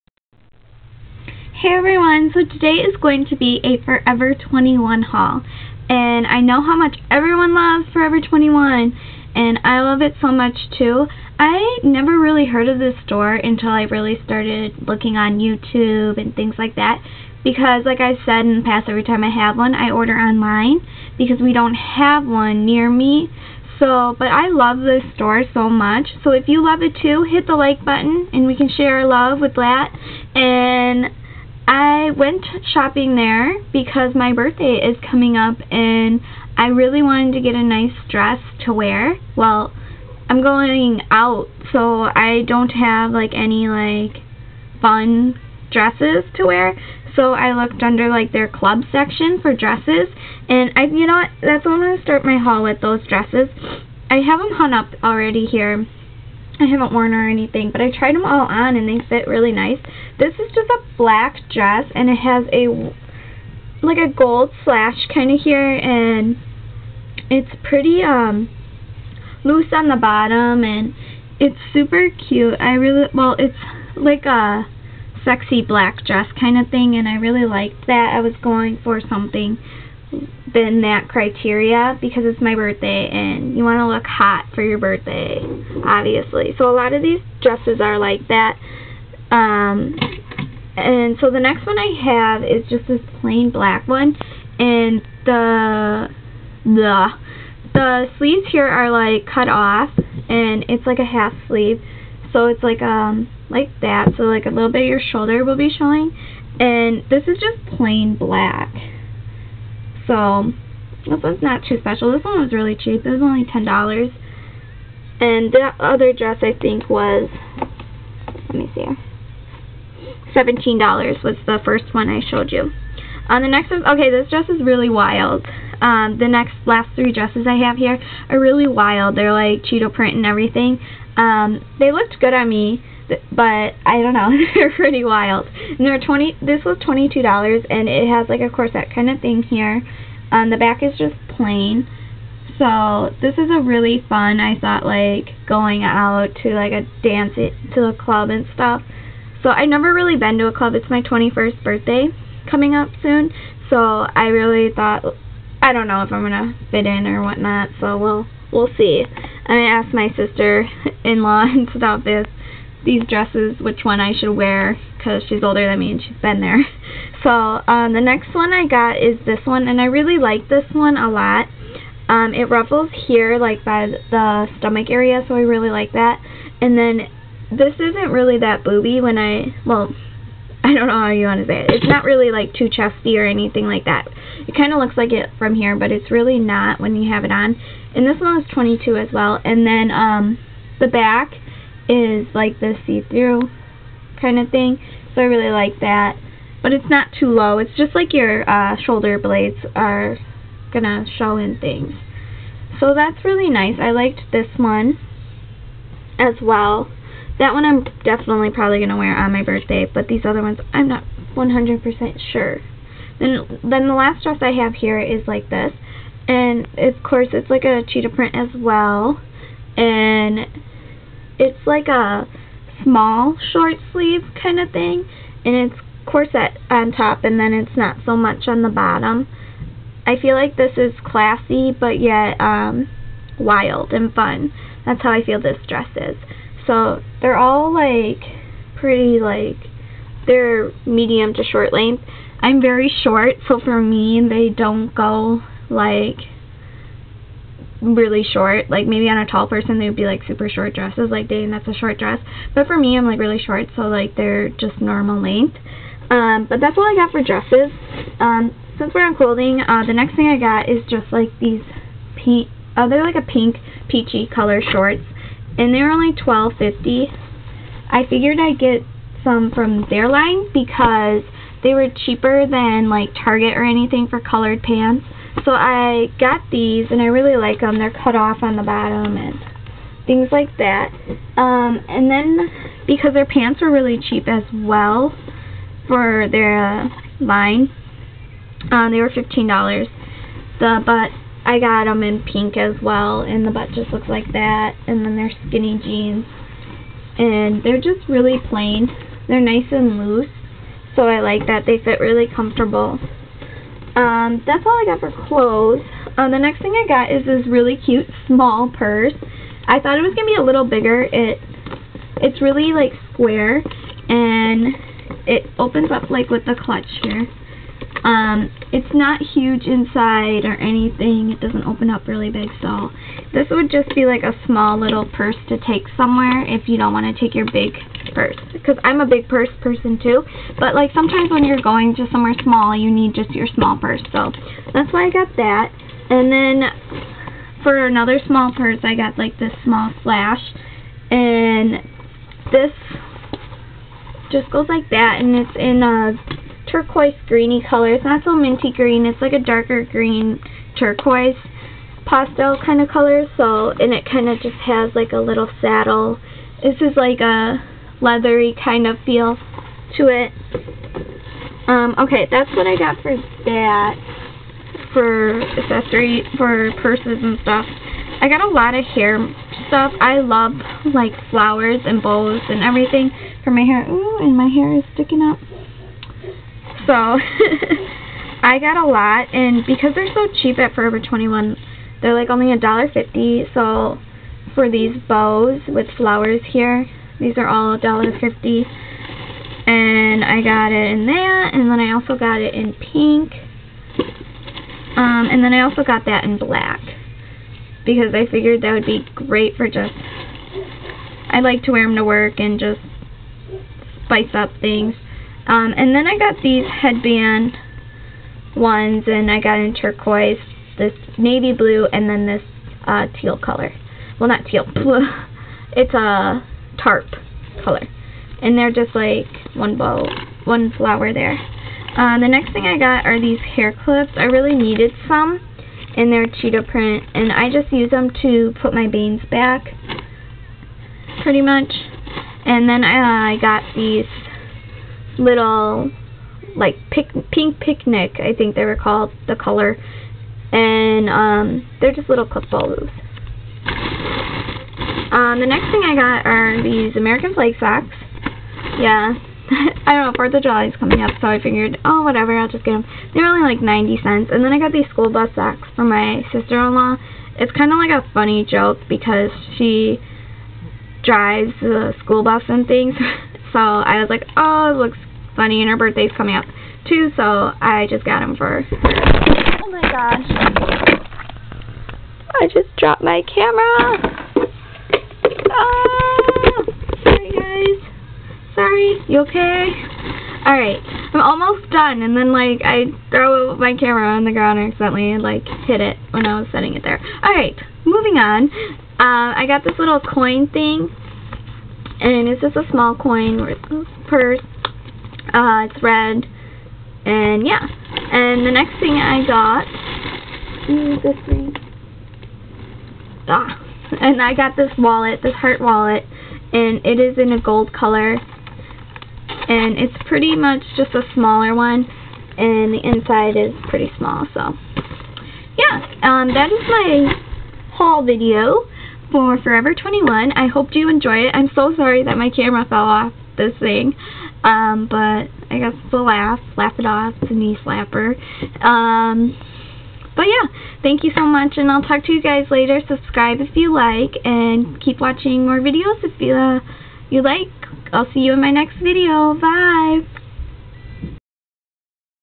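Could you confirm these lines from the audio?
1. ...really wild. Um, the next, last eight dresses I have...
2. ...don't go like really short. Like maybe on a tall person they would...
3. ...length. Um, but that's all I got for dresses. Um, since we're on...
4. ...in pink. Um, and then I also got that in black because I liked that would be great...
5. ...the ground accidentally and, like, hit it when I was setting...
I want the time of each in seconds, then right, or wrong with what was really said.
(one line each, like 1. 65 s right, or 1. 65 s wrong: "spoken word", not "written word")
1. 124 s wrong: "three", not "eight"
2. 244 s right
3. 255 s right
4. 392 s wrong: "figured", not "liked"
5. 484 s right.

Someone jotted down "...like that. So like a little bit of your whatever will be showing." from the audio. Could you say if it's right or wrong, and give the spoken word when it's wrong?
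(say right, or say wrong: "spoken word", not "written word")
wrong: "shoulder", not "whatever".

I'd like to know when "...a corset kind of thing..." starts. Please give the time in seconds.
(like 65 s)
138 s.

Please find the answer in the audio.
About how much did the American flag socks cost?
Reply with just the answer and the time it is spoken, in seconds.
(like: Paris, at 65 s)
90 cents, at 453 s.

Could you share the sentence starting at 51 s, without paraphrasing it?
that's what I'm gonna start my haul with those dresses.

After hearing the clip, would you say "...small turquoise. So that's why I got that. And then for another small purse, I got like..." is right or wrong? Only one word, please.
wrong.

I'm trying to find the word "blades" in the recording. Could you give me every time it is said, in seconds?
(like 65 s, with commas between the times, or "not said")
199 s.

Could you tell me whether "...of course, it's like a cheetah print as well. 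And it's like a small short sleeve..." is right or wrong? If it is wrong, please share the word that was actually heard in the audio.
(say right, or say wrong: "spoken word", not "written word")
right.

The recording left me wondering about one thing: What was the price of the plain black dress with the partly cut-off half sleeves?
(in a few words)
$10.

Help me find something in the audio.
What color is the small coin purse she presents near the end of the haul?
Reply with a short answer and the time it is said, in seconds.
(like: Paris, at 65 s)
red, at 495 s.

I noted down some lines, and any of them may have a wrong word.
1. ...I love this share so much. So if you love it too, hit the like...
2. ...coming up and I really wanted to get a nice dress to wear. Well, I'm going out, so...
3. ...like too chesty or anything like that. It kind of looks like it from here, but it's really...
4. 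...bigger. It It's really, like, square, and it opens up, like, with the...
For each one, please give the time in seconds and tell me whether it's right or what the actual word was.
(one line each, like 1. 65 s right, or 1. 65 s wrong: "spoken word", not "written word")
1. 24 s wrong: "store", not "share"
2. 35 s right
3. 182 s right
4. 310 s right.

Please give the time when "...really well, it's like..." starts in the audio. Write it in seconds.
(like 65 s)
72 s.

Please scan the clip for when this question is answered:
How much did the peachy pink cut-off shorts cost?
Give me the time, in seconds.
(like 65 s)
266 s.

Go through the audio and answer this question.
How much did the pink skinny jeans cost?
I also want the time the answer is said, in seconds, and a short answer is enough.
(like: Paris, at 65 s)
$15, at 289 s.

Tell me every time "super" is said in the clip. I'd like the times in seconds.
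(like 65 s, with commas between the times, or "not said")
71 s, 250 s.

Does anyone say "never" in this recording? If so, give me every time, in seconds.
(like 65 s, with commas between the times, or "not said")
11 s, 149 s.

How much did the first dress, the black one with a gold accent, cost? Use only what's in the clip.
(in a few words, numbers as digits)
$17.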